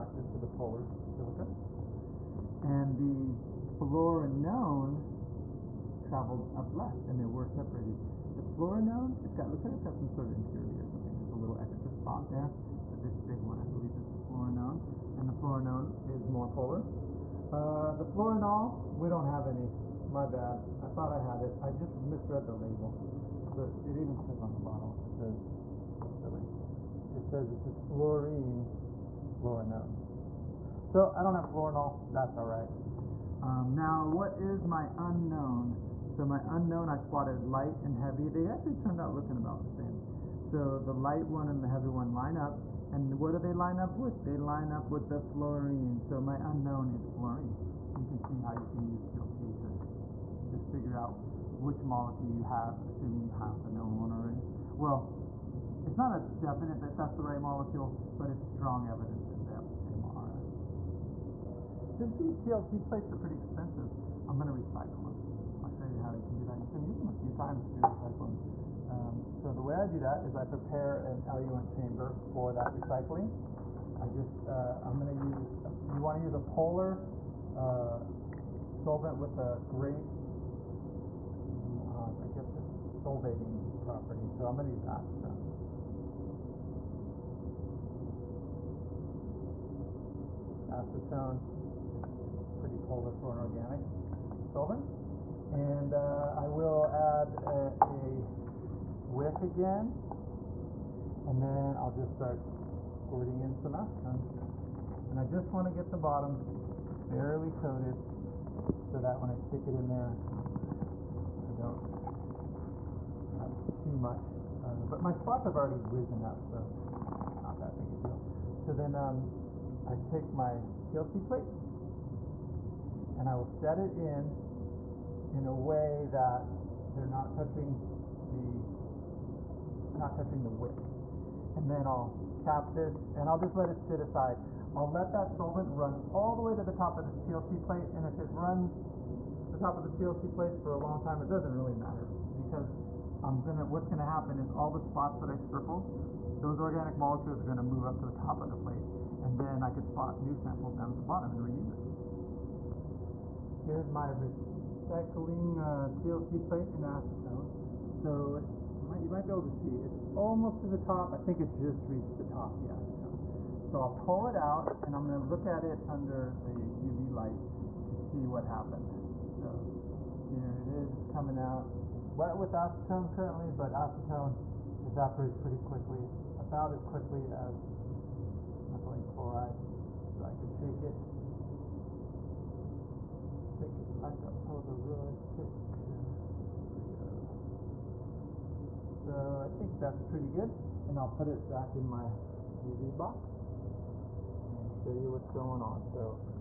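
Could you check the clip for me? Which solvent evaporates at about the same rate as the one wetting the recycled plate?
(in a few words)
methylene chloride.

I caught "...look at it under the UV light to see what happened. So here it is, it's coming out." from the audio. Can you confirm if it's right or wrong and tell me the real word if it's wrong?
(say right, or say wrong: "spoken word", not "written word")
right.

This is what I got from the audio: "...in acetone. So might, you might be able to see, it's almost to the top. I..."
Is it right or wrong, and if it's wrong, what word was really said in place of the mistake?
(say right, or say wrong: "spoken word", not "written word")
right.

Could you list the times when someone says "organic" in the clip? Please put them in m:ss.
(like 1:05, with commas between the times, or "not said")
1:33, 2:26.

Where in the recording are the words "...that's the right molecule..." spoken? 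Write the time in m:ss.
0:56.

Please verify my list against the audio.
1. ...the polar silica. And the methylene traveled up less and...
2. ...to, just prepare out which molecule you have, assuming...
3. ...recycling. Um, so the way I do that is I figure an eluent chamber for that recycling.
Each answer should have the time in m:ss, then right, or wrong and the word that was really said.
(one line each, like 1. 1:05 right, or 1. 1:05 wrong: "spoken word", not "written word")
1. 0:00 wrong: "fluorenone", not "methylene"
2. 0:49 wrong: "figure", not "prepare"
3. 1:07 wrong: "prepare", not "figure".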